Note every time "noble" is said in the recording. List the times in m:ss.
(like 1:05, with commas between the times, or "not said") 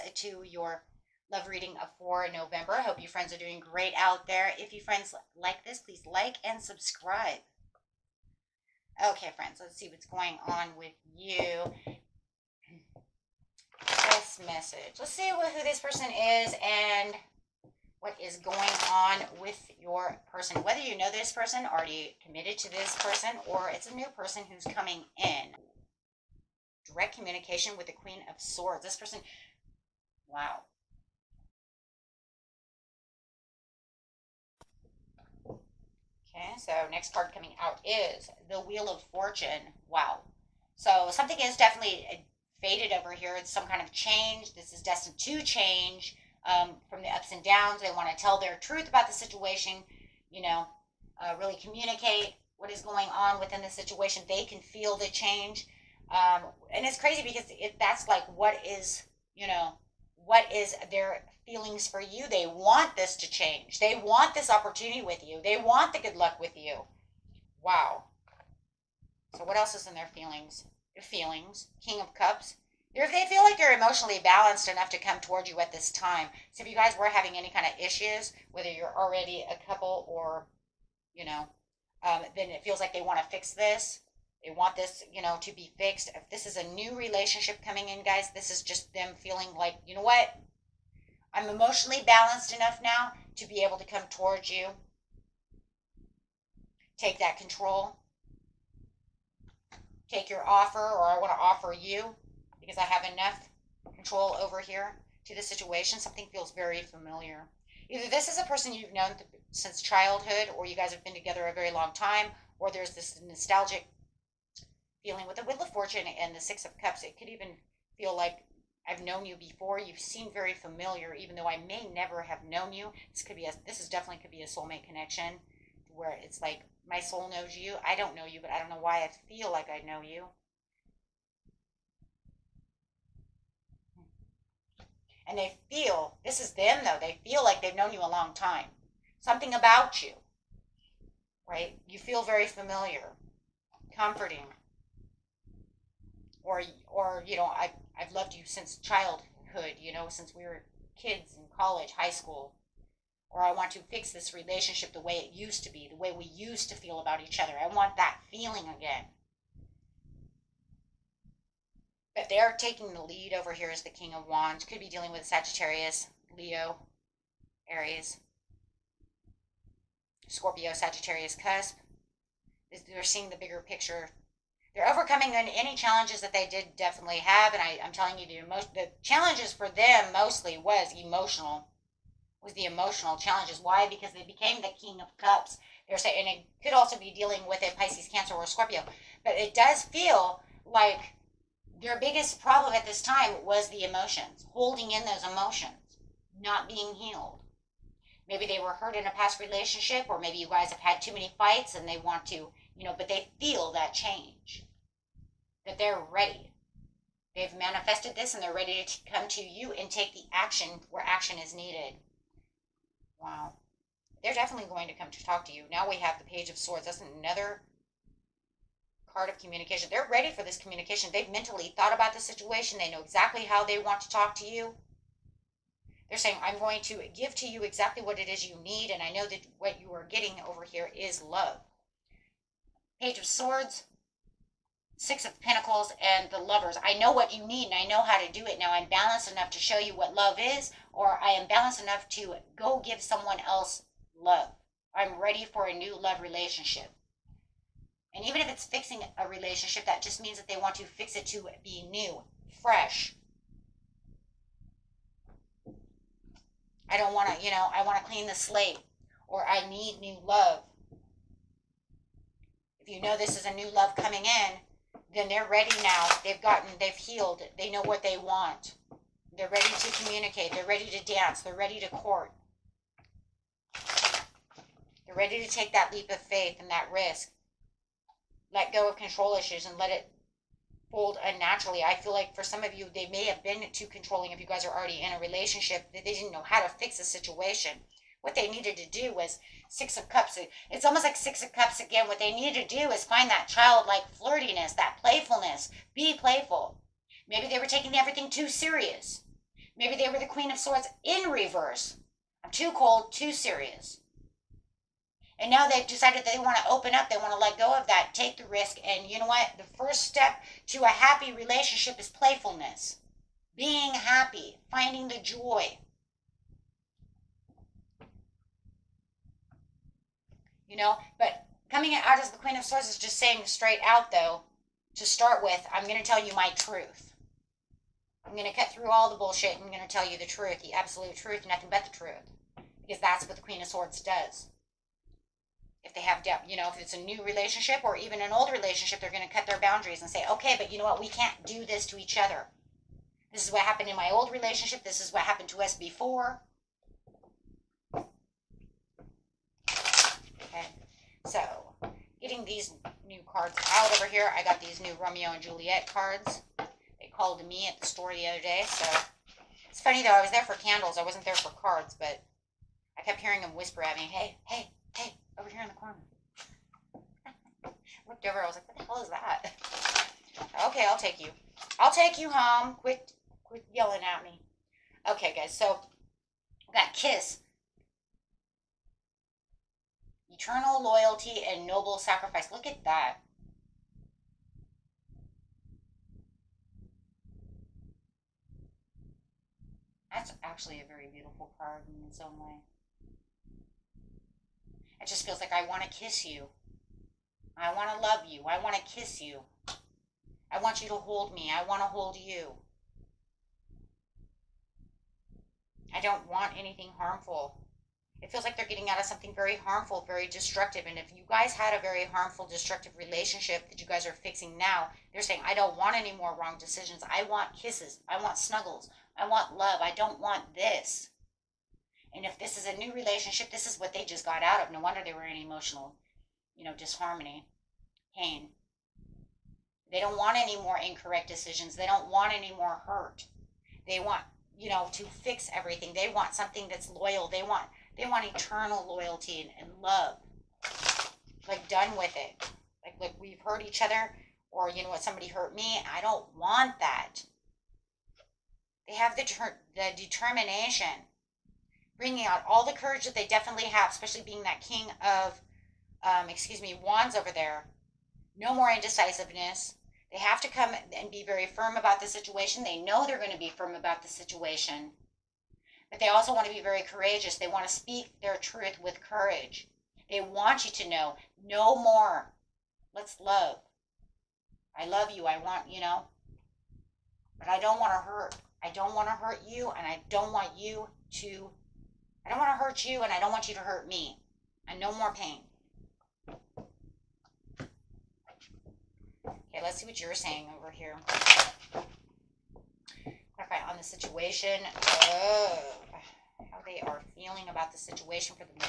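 6:21.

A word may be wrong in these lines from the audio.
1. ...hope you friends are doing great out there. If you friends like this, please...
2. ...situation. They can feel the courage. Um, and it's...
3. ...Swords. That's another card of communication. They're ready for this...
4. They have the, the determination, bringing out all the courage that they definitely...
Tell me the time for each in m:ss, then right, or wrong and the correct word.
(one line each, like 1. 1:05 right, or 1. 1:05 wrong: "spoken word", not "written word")
1. 0:02 right
2. 0:53 wrong: "change", not "courage"
3. 3:36 right
4. 7:28 right.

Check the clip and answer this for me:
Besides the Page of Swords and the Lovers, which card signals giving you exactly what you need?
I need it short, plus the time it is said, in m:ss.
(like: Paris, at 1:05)
Six of Pentacles, at 3:54.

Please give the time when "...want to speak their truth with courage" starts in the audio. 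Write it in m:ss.
7:47.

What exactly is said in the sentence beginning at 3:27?
They've manifested this and they're ready to come to you and take the action where action is needed.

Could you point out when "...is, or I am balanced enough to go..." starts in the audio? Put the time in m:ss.
4:00.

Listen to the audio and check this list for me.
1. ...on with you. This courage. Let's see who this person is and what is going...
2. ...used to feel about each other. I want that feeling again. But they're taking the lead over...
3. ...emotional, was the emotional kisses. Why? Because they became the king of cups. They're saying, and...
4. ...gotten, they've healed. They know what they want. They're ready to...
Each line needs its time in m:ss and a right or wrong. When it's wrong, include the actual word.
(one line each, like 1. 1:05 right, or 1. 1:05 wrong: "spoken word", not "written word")
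1. 0:10 wrong: "message", not "courage"
2. 2:36 right
3. 3:00 wrong: "challenges", not "kisses"
4. 4:26 right.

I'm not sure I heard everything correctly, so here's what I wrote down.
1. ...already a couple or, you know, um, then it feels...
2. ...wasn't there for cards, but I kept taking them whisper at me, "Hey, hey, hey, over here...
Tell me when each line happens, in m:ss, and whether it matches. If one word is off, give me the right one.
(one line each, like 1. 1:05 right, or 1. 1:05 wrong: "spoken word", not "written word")
1. 1:18 right
2. 6:01 wrong: "hearing", not "taking".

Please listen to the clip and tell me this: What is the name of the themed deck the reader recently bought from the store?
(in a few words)
Romeo and Juliet.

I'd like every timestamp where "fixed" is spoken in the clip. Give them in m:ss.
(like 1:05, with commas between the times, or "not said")
1:25.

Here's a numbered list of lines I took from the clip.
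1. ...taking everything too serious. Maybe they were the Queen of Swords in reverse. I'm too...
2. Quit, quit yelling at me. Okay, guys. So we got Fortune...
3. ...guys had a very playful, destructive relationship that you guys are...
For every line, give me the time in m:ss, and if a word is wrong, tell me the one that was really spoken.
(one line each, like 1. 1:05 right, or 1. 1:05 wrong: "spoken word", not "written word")
1. 4:57 right
2. 6:12 wrong: "Kiss", not "Fortune"
3. 6:51 wrong: "harmful", not "playful".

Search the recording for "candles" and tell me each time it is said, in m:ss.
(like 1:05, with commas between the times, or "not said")
6:00.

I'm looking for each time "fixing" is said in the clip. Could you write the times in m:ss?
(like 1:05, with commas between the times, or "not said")
4:08, 6:54.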